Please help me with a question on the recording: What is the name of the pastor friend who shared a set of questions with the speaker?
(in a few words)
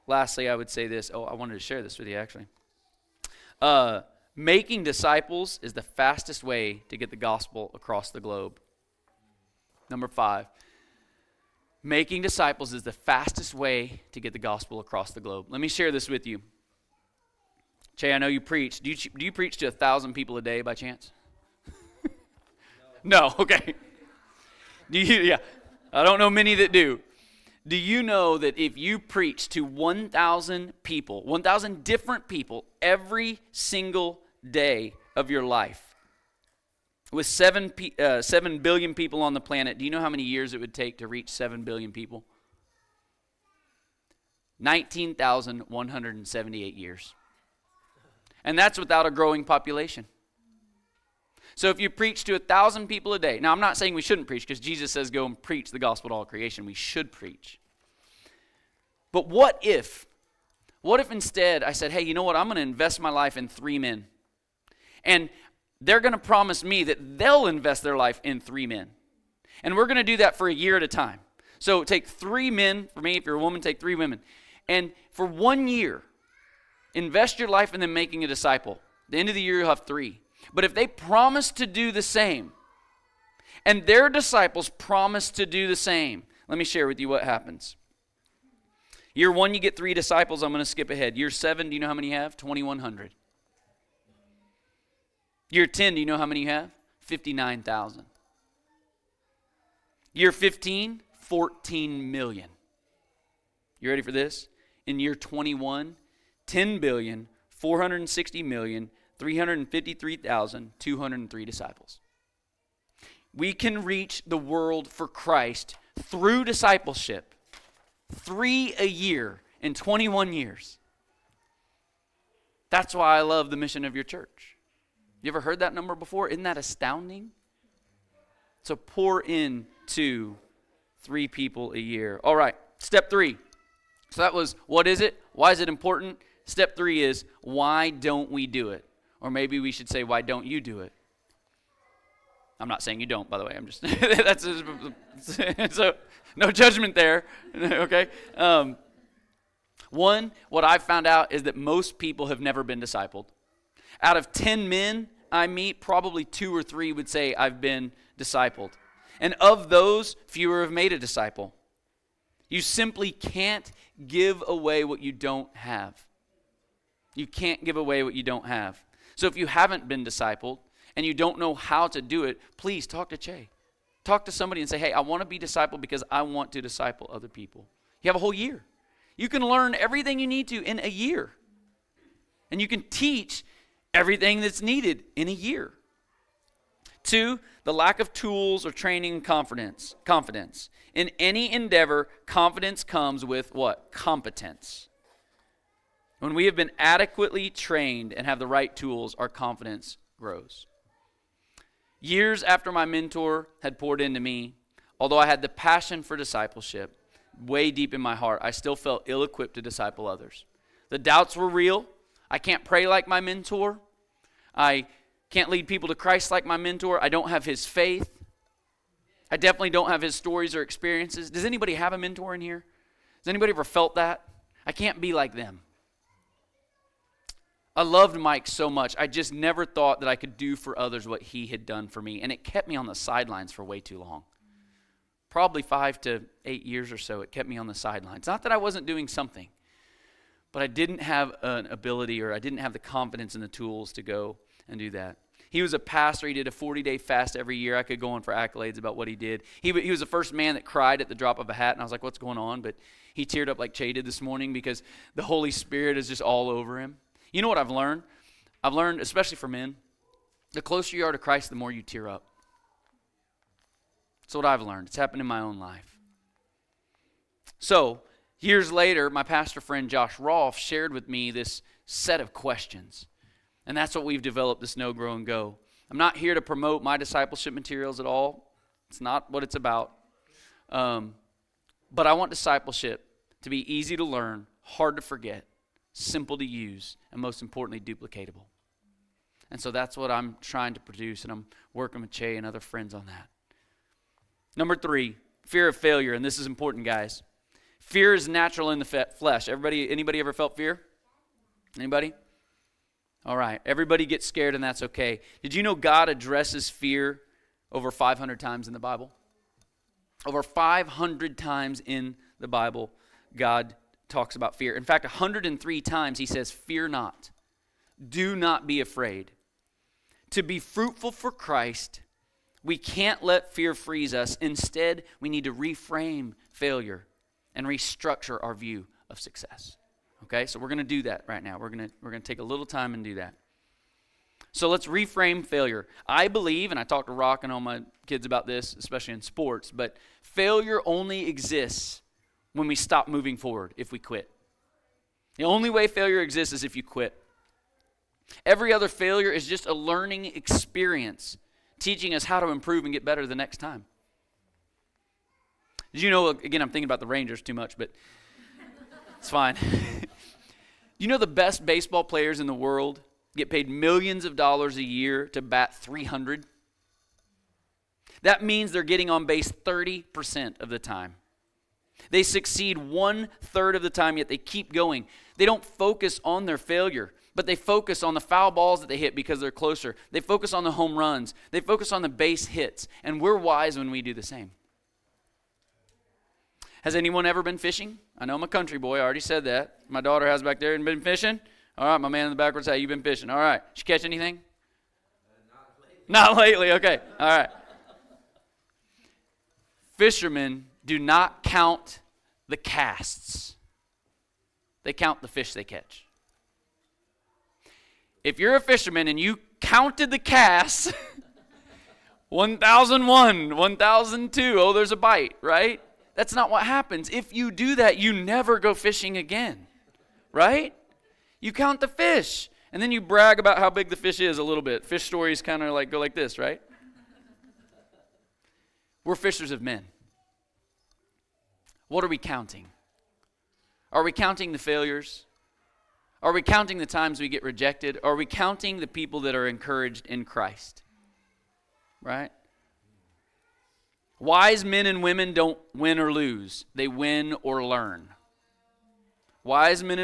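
Josh Rolfe.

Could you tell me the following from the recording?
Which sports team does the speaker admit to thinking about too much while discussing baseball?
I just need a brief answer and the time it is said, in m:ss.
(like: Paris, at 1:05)
Rangers, at 5:56.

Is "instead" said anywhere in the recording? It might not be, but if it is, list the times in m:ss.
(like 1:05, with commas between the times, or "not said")
1:01, 5:24.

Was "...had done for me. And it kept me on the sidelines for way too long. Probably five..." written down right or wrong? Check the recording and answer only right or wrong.
right.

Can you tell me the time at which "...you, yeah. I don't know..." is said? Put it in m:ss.
0:24.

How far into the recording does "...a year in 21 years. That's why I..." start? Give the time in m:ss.
1:58.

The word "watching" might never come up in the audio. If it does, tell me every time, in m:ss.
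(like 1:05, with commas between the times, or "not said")
not said.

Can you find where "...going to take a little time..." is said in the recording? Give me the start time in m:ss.
5:32.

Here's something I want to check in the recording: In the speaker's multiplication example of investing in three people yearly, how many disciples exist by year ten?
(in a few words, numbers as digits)
59,000.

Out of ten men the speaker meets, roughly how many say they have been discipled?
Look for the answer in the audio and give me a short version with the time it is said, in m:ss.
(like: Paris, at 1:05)
2 or 3, at 2:36.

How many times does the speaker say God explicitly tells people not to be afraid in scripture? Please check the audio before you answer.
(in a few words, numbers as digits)
103.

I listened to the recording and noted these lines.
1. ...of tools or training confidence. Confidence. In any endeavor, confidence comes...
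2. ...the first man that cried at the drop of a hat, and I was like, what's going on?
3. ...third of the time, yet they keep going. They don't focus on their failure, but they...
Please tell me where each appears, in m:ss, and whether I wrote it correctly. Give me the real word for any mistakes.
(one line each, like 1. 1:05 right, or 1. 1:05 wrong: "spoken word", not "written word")
1. 3:07 right
2. 4:09 right
3. 6:13 right.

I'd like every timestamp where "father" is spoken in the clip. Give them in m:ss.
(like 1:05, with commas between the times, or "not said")
not said.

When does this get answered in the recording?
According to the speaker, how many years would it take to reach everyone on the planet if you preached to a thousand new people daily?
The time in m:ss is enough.
0:44.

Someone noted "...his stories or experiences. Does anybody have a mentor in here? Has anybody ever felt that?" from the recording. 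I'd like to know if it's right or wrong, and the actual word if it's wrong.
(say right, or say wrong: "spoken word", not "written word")
right.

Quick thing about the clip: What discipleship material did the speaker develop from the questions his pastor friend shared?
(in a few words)
Know Grow and Go.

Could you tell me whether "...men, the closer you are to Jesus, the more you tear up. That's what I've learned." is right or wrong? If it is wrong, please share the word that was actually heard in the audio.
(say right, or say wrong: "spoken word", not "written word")
wrong: "Christ", not "Jesus".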